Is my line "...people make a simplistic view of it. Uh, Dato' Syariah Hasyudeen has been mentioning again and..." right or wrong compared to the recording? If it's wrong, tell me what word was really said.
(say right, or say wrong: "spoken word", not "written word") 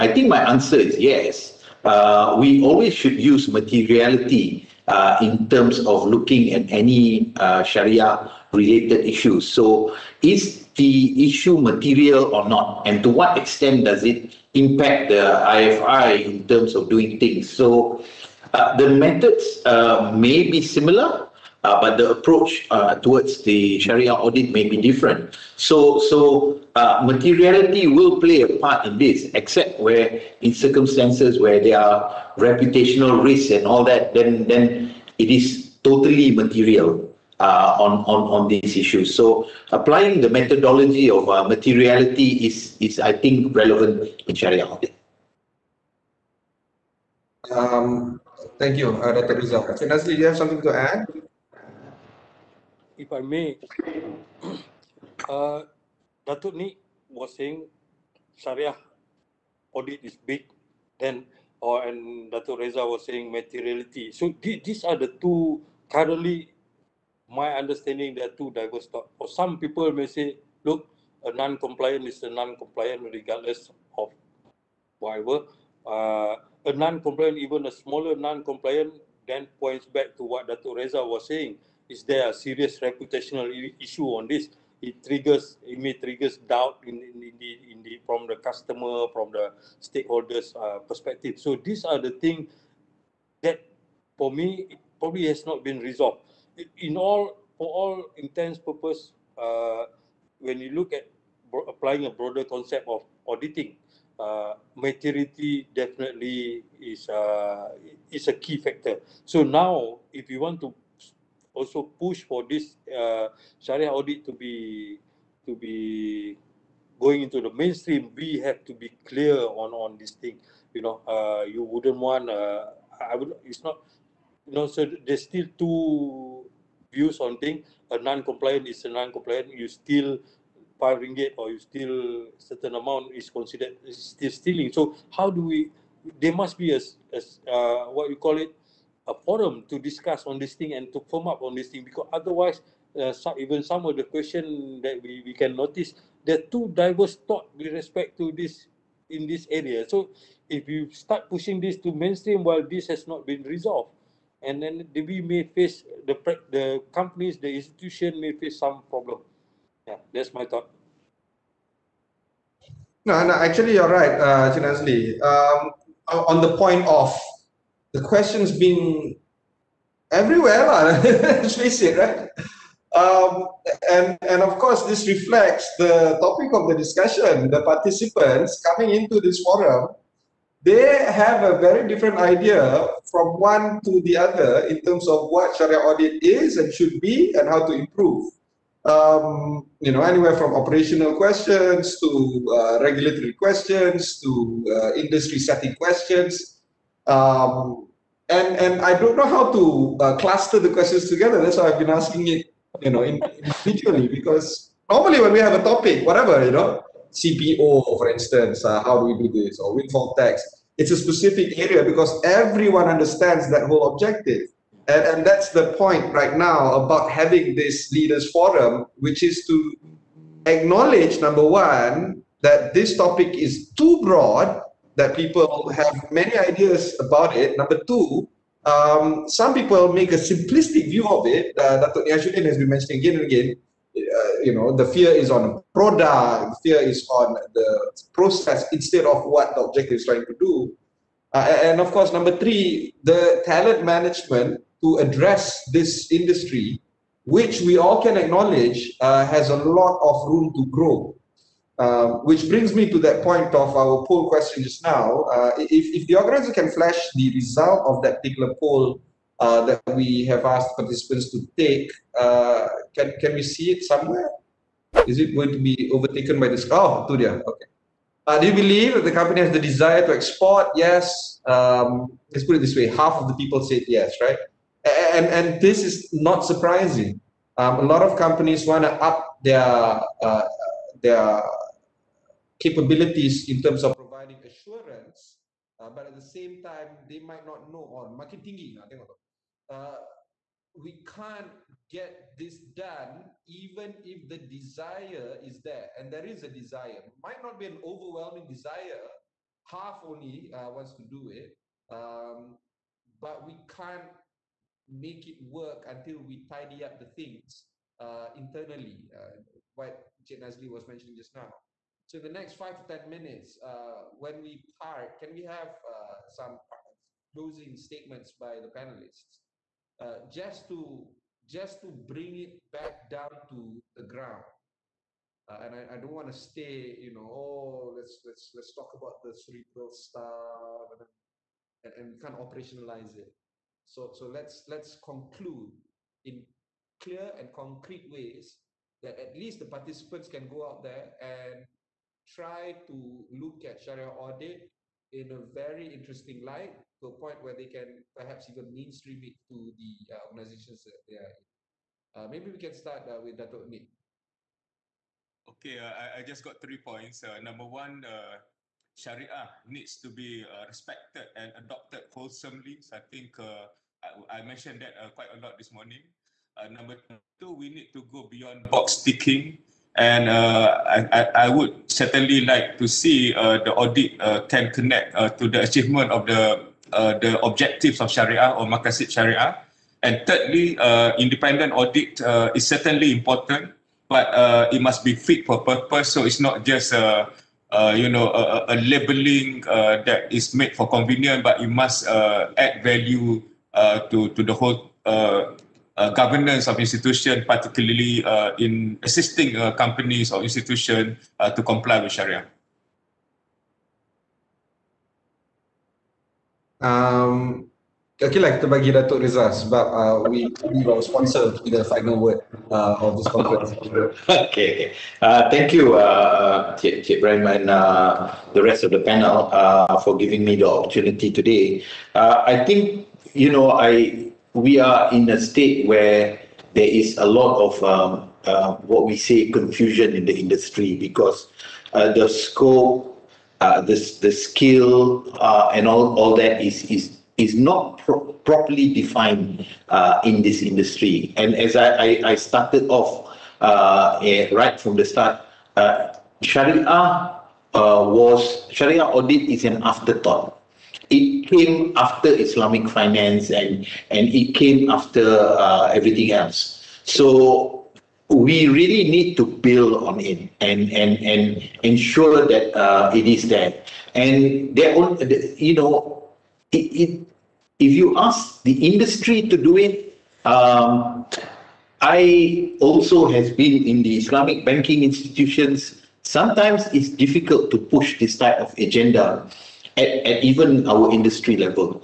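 wrong: "Nik", not "Syariah".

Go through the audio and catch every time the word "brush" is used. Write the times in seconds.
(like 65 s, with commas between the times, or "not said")
not said.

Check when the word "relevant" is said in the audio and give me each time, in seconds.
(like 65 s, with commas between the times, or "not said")
43 s.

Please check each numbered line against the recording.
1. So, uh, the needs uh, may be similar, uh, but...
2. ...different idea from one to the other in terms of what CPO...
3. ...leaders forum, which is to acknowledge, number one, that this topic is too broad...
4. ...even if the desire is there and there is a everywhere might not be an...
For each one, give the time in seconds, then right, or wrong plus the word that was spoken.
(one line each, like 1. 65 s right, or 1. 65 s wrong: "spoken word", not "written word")
1. 17 s wrong: "methods", not "needs"
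2. 181 s wrong: "Sharia", not "CPO"
3. 217 s right
4. 293 s wrong: "desire", not "everywhere".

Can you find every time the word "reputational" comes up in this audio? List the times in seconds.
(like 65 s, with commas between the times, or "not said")
32 s, 82 s.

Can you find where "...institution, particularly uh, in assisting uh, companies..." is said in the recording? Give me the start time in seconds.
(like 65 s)
396 s.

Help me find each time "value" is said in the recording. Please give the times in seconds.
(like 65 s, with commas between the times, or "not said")
392 s.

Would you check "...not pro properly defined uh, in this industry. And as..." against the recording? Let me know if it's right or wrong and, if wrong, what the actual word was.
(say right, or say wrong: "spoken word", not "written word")
right.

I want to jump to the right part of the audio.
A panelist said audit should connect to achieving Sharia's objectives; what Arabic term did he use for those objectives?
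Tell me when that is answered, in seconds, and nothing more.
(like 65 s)
378 s.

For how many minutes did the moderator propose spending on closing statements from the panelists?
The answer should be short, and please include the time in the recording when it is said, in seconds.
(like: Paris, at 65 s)
5 to 10 minutes, at 312 s.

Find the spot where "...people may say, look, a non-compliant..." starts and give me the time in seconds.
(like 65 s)
69 s.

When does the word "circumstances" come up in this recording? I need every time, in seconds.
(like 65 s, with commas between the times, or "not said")
30 s.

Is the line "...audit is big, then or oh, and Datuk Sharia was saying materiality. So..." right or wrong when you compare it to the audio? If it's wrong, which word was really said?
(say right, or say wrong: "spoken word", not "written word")
wrong: "Reza", not "Sharia".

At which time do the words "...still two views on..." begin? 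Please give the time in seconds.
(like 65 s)
125 s.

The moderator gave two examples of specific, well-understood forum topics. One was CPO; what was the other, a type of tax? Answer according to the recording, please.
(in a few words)
Windfall tax.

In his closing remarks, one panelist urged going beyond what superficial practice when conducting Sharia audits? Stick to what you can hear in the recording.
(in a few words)
Box ticking.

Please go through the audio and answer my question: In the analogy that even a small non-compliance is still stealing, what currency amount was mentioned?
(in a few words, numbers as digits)
5 ringgit.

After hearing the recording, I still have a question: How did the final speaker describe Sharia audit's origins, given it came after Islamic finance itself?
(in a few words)
An afterthought.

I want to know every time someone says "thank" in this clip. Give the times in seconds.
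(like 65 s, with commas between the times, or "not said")
48 s, 415 s.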